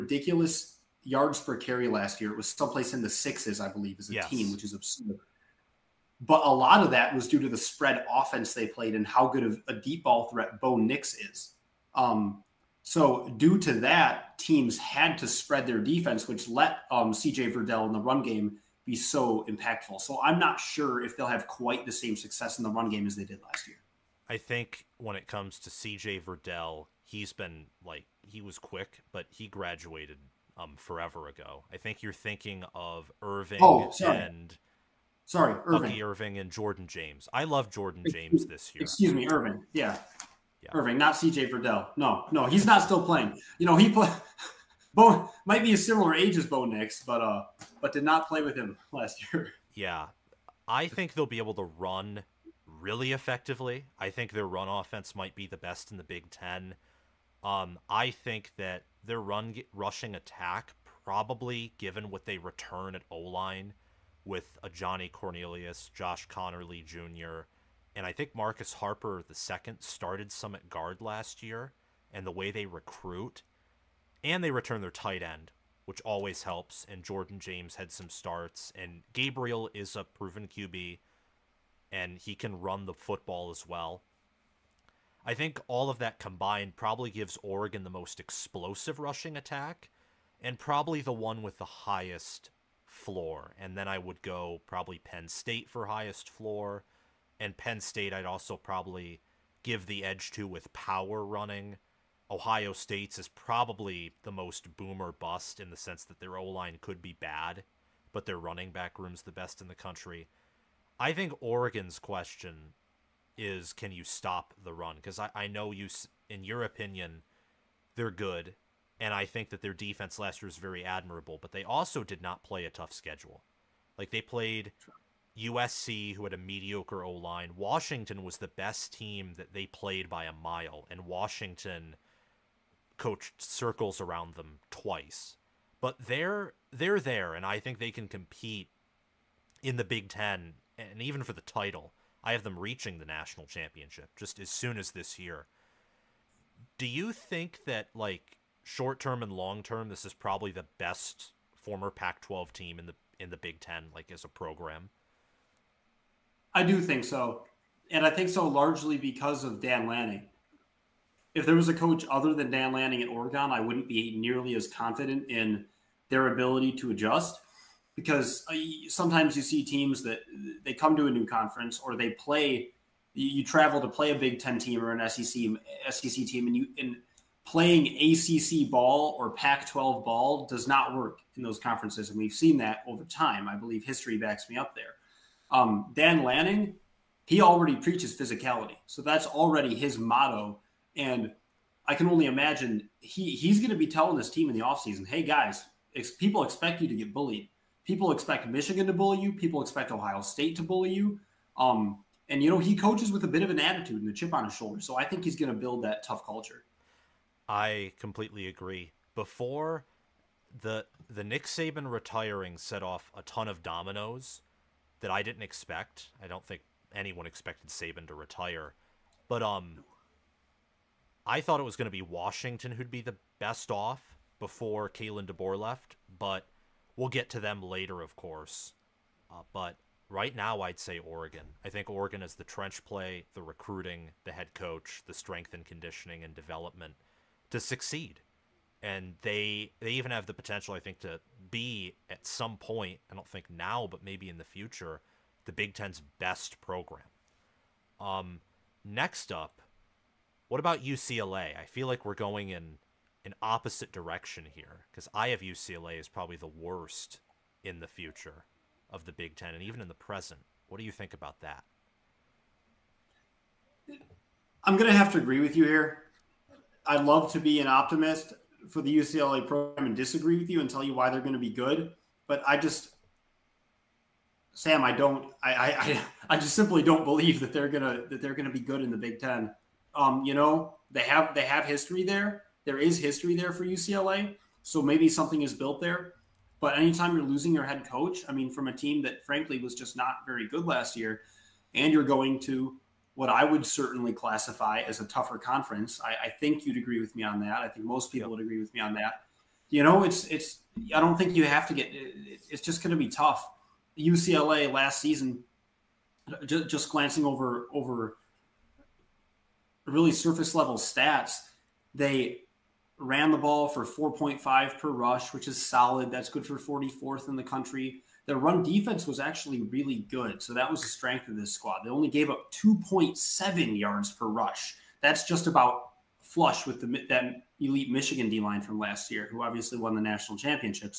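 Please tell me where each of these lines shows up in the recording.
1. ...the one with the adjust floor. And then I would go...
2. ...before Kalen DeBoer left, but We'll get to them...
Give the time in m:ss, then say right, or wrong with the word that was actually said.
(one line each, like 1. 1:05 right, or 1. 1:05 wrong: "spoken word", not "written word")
1. 1:31 wrong: "highest", not "adjust"
2. 3:44 right.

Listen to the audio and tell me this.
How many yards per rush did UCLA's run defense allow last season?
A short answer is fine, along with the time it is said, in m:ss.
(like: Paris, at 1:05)
2.7, at 5:22.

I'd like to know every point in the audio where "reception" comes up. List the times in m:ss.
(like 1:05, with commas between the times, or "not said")
not said.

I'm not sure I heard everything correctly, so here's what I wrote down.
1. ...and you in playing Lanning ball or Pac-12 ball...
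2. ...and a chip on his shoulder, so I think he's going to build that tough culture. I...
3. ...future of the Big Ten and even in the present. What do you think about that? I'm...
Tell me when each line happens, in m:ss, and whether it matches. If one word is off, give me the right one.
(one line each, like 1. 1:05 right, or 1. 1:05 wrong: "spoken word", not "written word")
1. 2:56 wrong: "ACC", not "Lanning"
2. 3:24 right
3. 4:17 right.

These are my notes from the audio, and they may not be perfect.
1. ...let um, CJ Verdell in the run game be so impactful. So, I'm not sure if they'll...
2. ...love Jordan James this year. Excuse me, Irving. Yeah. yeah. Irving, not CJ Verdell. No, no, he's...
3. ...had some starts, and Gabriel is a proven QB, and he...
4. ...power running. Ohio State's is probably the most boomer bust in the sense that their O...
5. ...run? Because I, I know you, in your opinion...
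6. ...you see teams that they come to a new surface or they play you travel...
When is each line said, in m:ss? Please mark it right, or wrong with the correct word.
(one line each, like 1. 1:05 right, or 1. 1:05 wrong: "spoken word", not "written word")
1. 0:16 right
2. 0:37 right
3. 1:17 right
4. 1:40 right
5. 1:54 right
6. 2:49 wrong: "conference", not "surface".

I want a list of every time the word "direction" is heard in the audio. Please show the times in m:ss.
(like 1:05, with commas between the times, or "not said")
4:13.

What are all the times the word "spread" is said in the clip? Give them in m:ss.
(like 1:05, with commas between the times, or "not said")
0:07, 0:15.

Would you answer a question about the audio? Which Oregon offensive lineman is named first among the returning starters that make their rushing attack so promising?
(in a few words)
Ajani Cornelius.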